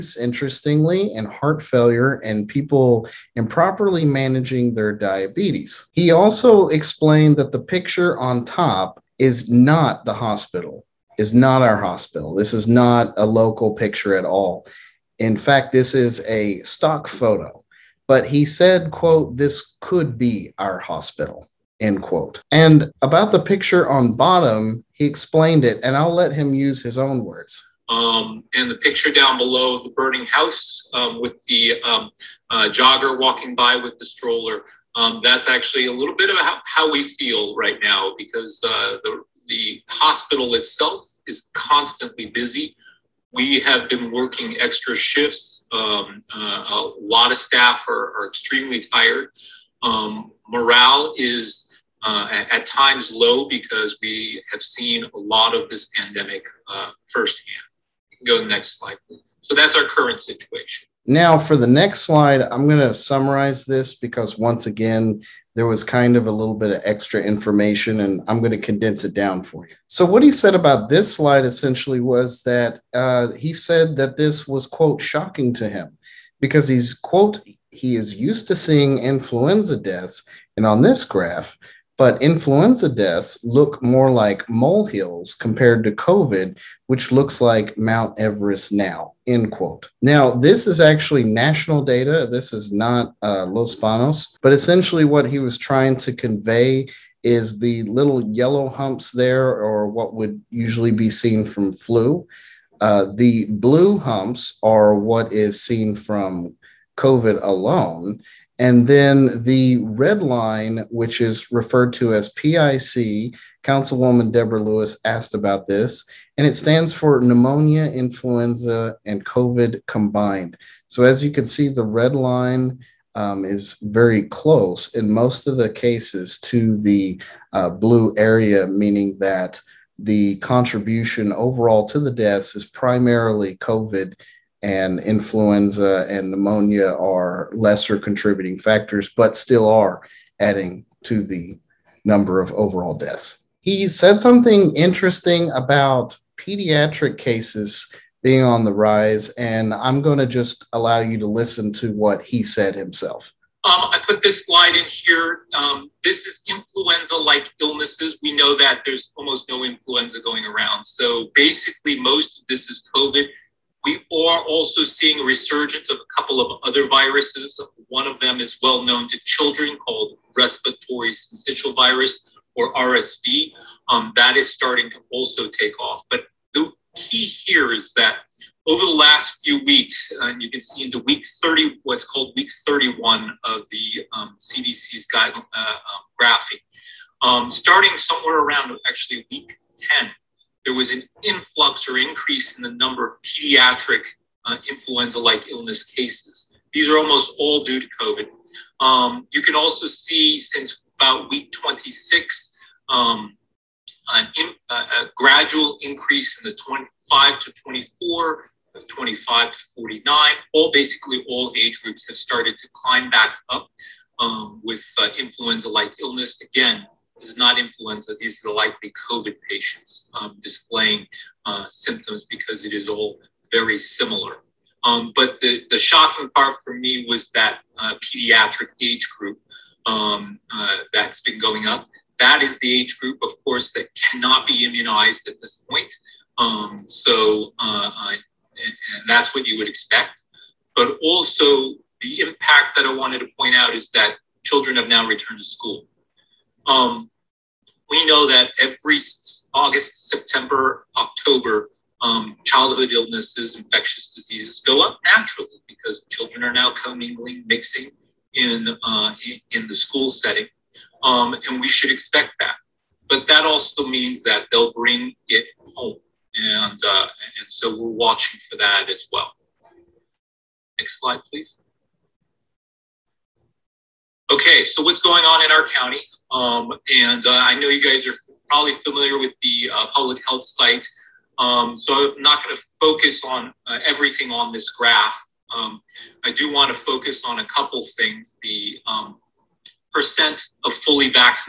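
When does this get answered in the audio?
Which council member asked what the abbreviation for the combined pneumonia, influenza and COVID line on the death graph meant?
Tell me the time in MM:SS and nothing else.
01:54.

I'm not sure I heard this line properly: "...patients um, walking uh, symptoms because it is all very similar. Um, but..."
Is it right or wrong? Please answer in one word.
wrong.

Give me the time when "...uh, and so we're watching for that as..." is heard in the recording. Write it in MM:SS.
04:26.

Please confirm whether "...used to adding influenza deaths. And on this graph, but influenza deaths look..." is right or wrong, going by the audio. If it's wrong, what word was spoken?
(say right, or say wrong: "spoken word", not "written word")
wrong: "seeing", not "adding".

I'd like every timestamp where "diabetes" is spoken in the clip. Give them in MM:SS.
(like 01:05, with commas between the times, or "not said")
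00:04.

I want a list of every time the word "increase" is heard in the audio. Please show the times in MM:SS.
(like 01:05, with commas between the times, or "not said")
03:11, 03:25.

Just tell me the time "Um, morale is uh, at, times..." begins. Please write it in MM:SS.
00:49.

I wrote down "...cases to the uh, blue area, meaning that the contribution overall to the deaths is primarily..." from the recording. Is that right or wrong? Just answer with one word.
right.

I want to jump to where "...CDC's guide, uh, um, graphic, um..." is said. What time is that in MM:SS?
03:04.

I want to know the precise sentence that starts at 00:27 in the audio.
Um, and the picture down below the burning house um, with the um, uh, jogger walking by with the stroller.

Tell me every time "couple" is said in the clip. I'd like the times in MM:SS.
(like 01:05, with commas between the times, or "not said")
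02:46, 04:47.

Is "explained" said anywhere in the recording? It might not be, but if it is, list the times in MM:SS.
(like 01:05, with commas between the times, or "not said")
00:06, 00:25.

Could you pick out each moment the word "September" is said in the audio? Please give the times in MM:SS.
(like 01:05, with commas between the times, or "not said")
04:10.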